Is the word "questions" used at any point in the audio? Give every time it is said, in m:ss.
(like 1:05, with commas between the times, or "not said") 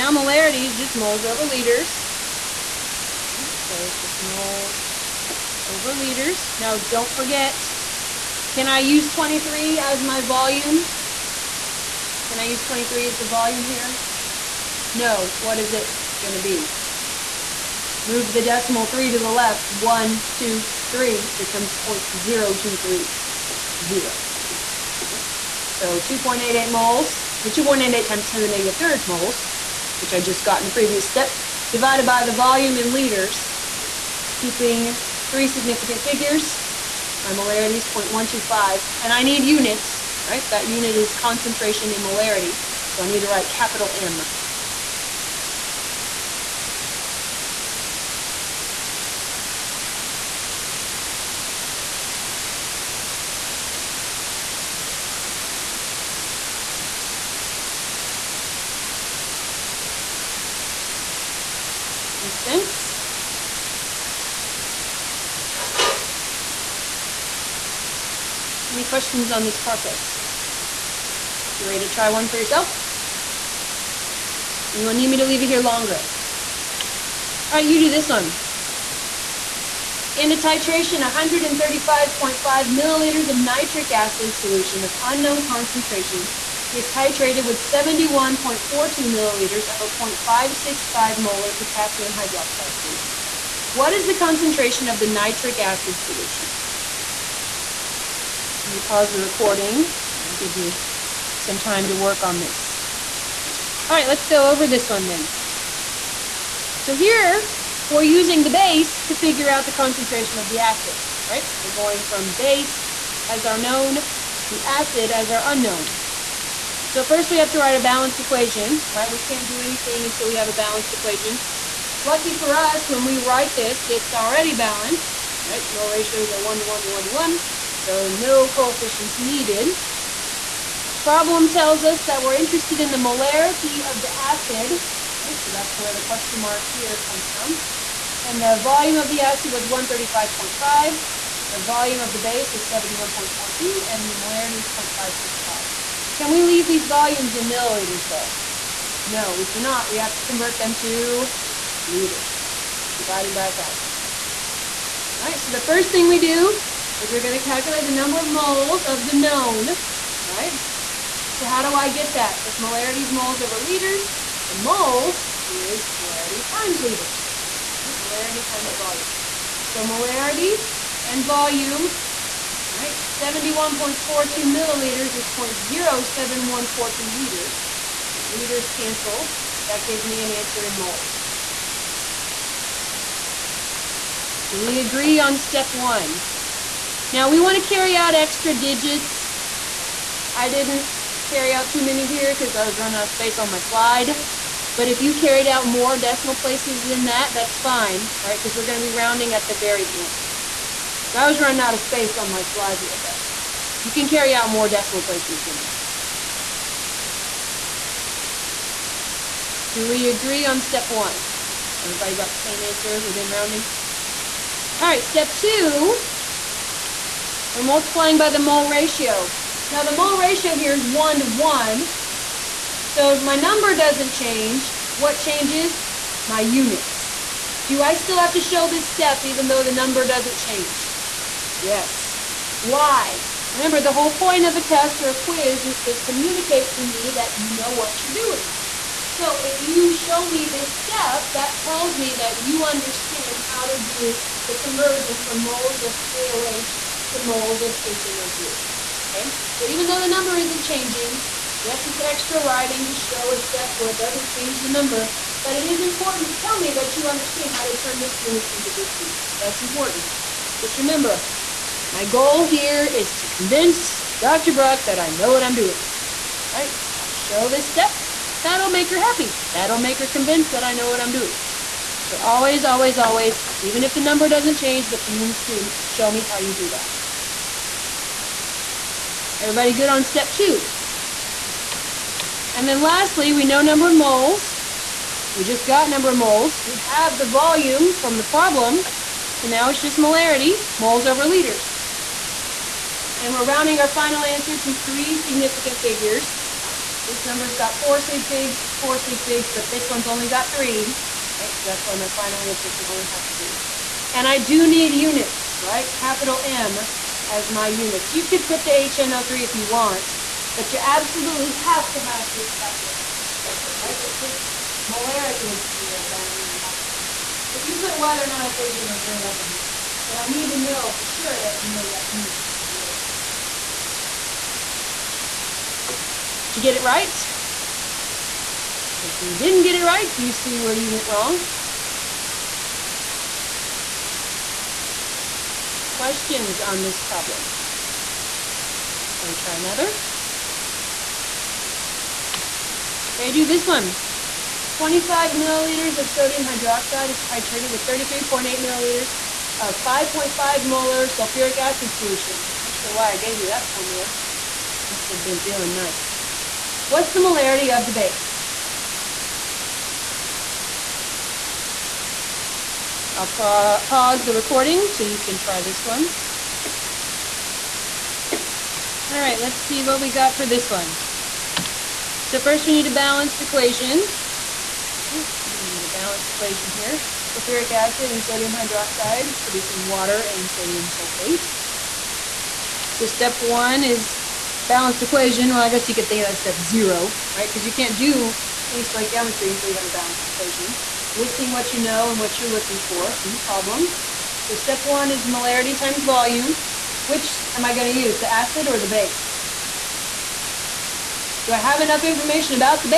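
1:08, 2:16, 5:35.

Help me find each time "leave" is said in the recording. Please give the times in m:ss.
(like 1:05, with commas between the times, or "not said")
1:15, 2:26.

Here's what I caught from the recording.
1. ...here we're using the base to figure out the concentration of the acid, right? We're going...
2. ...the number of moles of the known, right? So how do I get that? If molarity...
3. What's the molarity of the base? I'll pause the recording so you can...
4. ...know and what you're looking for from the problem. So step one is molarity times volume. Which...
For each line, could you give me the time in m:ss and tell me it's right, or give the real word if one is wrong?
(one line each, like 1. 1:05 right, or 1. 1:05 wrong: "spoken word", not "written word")
1. 1:46 right
2. 2:37 right
3. 5:56 right
4. 6:31 right.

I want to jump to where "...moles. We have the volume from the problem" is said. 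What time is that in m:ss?
4:46.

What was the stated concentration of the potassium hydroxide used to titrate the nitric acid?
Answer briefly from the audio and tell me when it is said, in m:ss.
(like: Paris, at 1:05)
0.565 molar, at 1:30.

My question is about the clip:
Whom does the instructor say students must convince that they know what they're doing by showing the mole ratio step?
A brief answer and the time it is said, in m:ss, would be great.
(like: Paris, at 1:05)
Dr. Bruck, at 4:24.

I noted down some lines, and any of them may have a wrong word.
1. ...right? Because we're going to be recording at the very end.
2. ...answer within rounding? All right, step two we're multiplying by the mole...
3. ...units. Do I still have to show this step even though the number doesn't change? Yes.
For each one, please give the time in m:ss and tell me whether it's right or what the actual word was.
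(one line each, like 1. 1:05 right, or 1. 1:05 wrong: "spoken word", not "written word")
1. 3:18 wrong: "rounding", not "recording"
2. 3:32 right
3. 3:46 right.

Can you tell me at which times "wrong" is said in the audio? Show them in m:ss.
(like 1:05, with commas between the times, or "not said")
5:16, 5:31.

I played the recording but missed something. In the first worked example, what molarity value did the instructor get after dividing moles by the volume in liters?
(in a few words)
0.125.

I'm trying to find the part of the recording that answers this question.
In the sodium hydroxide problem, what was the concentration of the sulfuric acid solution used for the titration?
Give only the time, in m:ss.
5:49.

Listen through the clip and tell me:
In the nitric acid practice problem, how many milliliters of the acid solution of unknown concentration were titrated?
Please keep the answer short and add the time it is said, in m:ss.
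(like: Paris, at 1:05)
135.5 milliliters, at 1:20.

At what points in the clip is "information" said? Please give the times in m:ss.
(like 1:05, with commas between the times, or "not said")
6:42.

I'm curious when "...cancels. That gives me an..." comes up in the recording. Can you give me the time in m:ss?
2:58.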